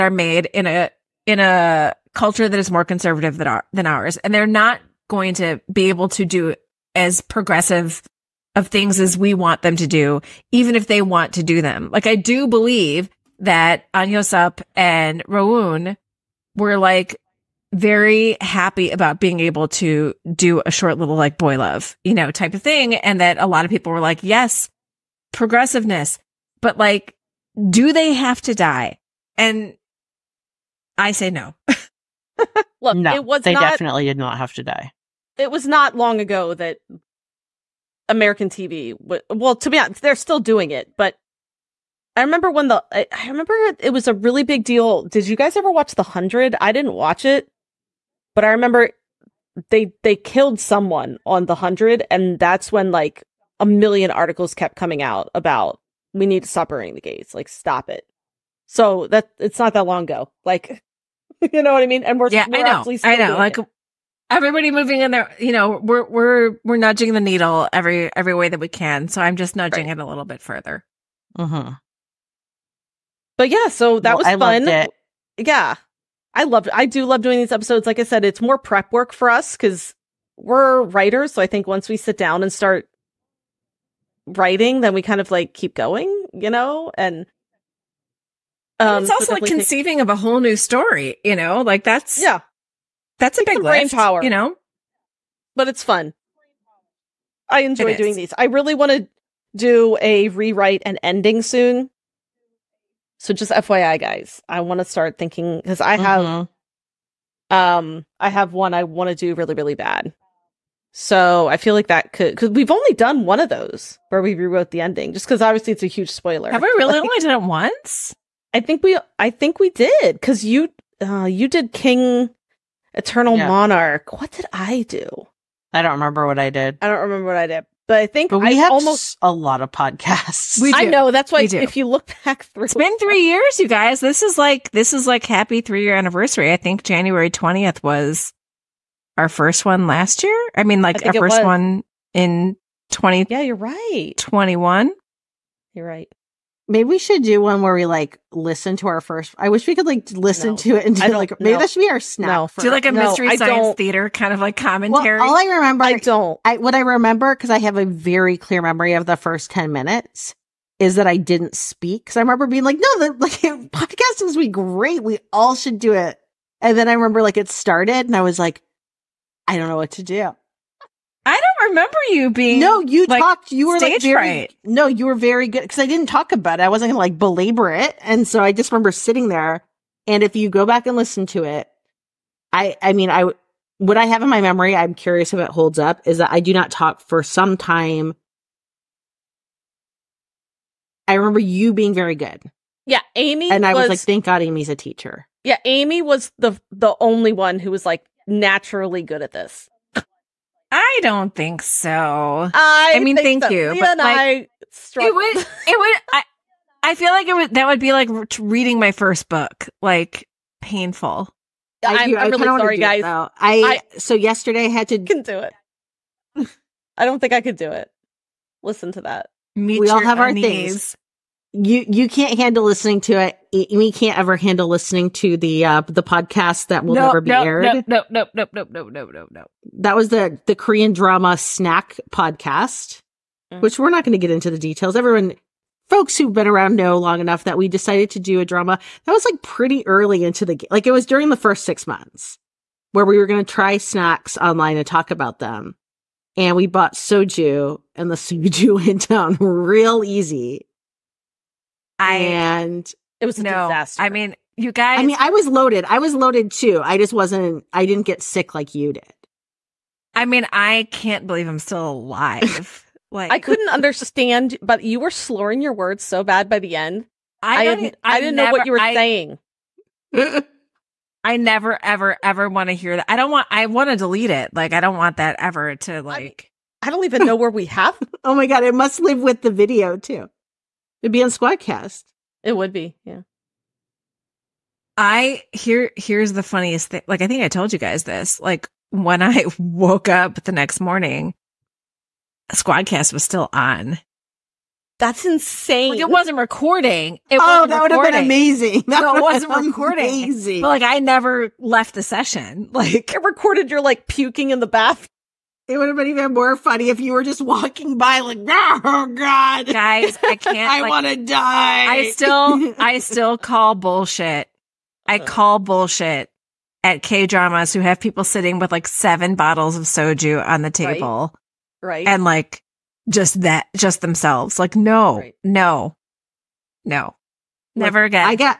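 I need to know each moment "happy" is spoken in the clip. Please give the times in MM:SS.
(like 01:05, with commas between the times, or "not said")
00:18, 02:15.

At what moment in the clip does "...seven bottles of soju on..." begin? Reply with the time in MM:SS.
05:18.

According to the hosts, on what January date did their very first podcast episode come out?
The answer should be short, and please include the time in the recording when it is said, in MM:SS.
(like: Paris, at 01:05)
January 20, at 02:16.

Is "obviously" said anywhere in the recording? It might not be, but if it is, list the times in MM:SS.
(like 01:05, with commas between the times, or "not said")
01:55.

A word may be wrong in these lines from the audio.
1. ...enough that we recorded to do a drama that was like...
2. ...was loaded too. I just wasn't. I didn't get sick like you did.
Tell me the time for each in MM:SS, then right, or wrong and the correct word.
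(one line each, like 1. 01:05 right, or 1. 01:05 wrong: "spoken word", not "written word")
1. 03:57 wrong: "decided", not "recorded"
2. 04:15 right.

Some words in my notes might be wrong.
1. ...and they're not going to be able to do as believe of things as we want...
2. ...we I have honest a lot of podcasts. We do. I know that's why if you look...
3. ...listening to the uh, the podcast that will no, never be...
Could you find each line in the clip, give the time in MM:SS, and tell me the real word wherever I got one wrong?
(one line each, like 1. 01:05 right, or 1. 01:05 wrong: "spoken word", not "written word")
1. 00:04 wrong: "progressive", not "believe"
2. 02:08 wrong: "almost", not "honest"
3. 03:44 right.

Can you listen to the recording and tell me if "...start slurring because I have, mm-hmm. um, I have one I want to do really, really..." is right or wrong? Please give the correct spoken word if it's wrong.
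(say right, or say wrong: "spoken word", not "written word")
wrong: "thinking", not "slurring".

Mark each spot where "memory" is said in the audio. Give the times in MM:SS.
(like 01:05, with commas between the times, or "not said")
02:38, 03:04.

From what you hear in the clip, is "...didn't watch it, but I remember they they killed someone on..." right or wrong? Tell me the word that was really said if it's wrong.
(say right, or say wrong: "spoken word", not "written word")
right.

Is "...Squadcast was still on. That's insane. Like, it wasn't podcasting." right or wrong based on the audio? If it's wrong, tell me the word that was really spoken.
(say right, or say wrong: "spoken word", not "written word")
wrong: "recording", not "podcasting".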